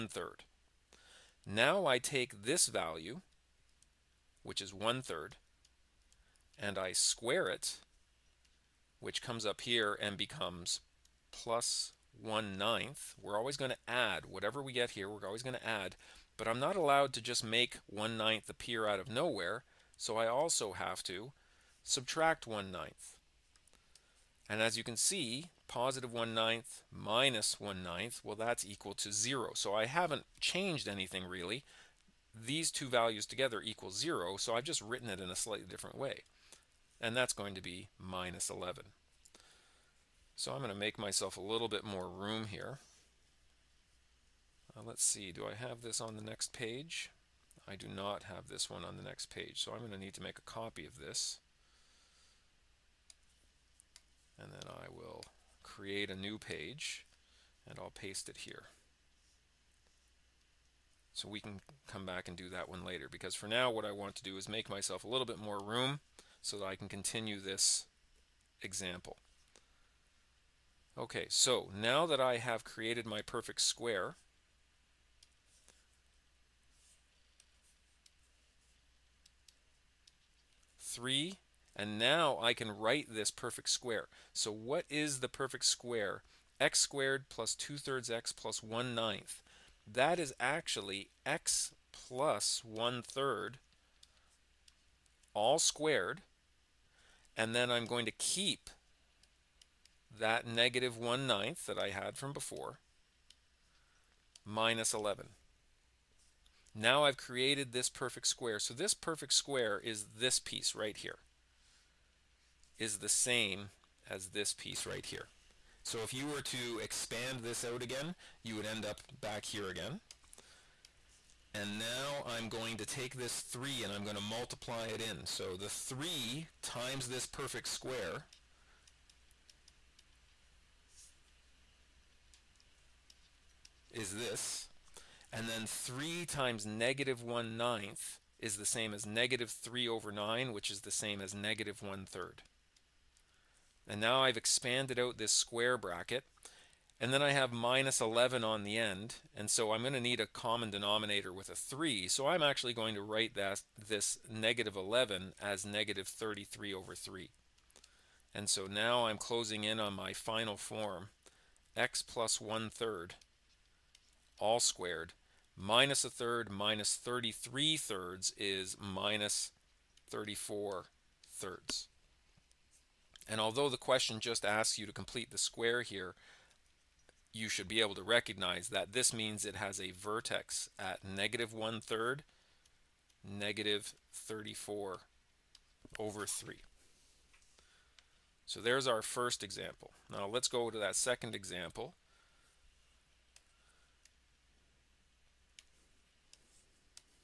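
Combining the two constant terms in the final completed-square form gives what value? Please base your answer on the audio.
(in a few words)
-34/3.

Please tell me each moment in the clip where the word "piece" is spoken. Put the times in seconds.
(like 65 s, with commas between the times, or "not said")
110 s, 114 s.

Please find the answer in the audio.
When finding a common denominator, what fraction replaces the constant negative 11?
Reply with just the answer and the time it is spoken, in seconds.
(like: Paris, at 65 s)
-33/3, at 155 s.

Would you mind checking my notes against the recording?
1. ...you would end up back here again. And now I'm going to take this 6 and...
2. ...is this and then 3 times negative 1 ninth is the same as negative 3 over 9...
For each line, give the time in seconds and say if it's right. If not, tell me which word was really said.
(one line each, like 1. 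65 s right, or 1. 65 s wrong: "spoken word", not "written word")
1. 118 s wrong: "3", not "6"
2. 133 s right.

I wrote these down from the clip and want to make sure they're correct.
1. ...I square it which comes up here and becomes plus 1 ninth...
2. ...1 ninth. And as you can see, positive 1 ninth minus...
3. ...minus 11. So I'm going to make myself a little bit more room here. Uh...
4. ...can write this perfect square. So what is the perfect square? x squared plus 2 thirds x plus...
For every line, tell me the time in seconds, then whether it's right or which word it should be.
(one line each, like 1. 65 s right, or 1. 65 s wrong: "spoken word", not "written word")
1. 6 s right
2. 22 s right
3. 37 s right
4. 82 s right.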